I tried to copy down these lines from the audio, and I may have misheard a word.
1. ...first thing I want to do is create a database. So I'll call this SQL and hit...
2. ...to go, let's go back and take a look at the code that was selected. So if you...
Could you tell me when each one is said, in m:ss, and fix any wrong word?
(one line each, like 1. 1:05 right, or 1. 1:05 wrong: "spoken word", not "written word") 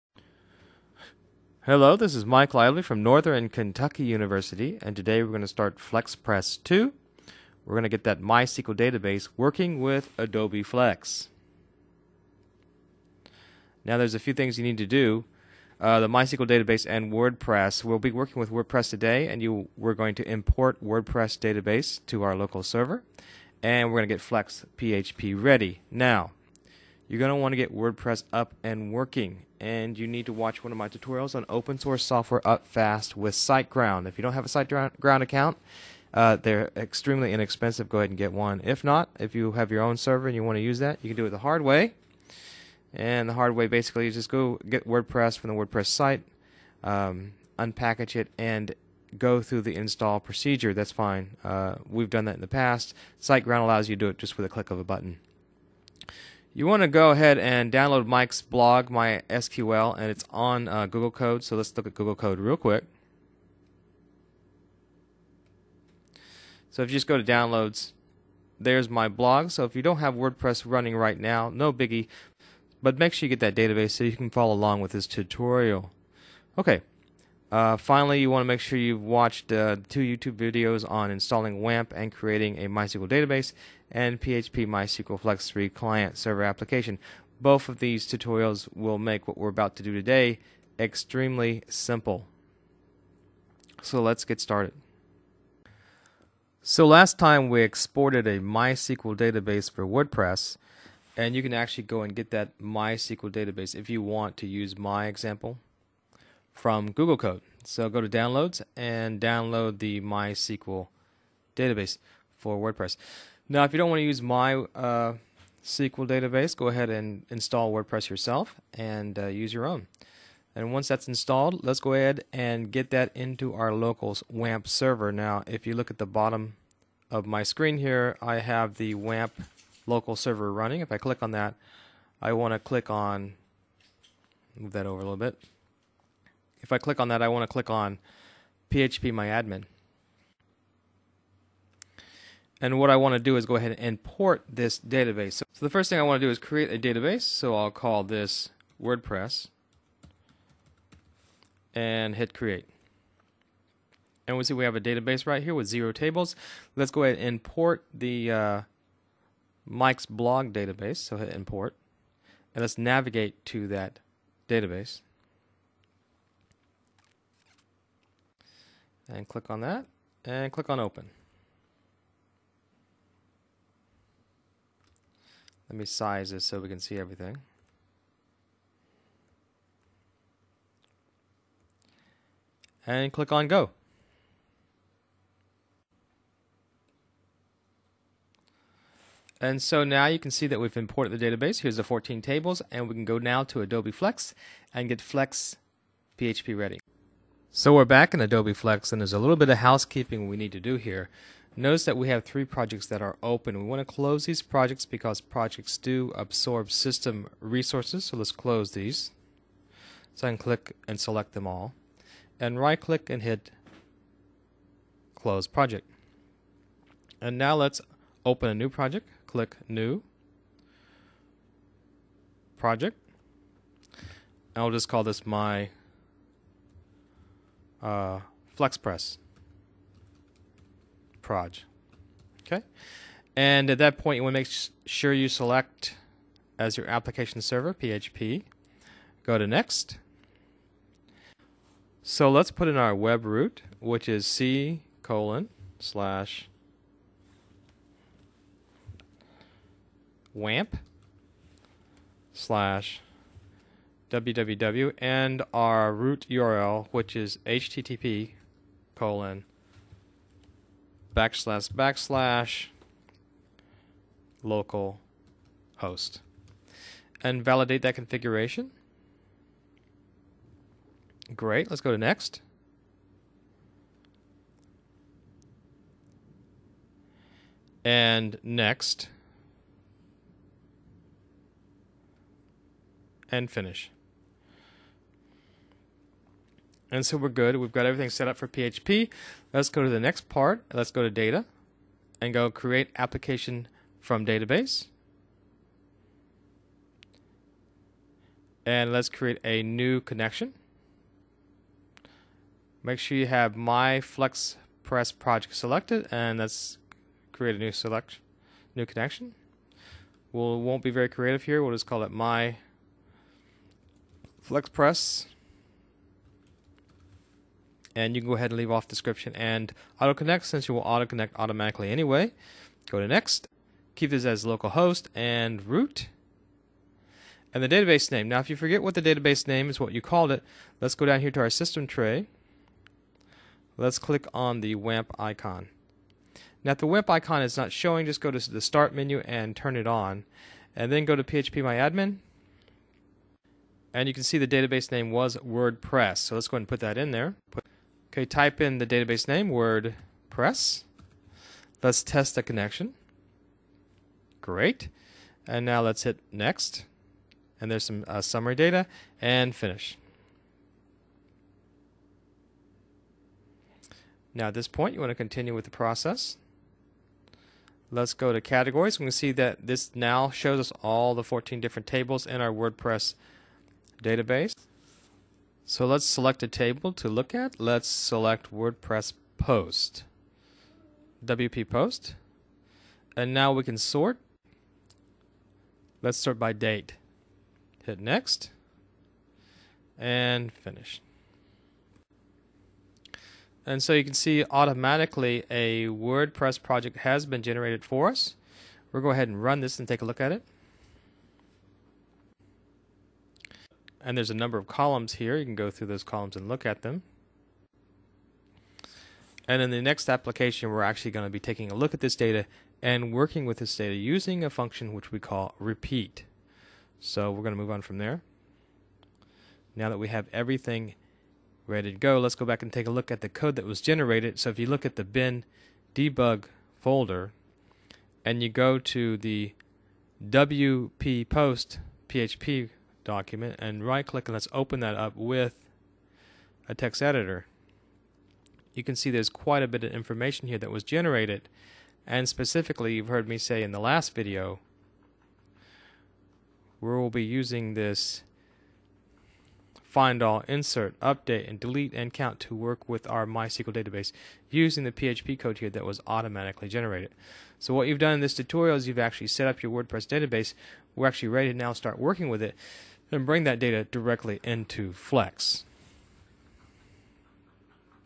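1. 2:25 wrong: "WordPress", not "SQL"
2. 7:01 wrong: "generated", not "selected".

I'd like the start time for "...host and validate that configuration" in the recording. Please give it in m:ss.
4:25.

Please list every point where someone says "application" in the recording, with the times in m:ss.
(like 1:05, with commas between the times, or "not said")
1:26, 3:56, 4:52, 6:50.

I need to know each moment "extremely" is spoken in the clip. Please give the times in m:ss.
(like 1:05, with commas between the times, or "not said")
0:36, 1:30.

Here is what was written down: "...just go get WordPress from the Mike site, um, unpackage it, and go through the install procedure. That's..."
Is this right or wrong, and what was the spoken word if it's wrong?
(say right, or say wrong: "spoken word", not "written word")
wrong: "WordPress", not "Mike".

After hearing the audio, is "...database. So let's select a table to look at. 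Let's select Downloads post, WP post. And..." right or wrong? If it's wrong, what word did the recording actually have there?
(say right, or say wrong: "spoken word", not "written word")
wrong: "WordPress", not "Downloads".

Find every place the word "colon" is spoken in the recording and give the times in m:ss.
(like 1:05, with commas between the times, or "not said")
4:05, 4:18.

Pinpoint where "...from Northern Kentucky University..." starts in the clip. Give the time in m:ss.
0:02.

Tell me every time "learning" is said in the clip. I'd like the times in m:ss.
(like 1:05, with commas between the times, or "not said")
not said.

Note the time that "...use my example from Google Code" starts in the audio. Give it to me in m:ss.
1:44.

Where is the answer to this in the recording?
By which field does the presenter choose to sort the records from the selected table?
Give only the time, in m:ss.
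6:26.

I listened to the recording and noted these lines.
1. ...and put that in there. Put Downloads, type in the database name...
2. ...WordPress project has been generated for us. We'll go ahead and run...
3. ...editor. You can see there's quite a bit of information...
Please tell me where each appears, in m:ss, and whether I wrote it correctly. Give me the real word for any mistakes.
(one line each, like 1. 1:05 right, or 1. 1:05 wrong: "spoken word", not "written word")
1. 5:46 wrong: "Okay", not "Downloads"
2. 6:35 right
3. 7:17 right.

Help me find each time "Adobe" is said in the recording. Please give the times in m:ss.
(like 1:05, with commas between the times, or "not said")
0:10, 3:13, 3:18.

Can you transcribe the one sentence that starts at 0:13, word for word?
Now there's a few things you need to do.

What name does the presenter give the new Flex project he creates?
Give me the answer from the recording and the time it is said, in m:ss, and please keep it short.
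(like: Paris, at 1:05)
FlexPress proj, at 3:48.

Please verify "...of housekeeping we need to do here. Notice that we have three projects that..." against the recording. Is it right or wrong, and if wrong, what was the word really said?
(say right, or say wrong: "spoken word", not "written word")
right.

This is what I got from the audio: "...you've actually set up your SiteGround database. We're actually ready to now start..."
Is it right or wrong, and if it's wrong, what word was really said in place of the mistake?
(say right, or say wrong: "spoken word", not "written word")
wrong: "WordPress", not "SiteGround".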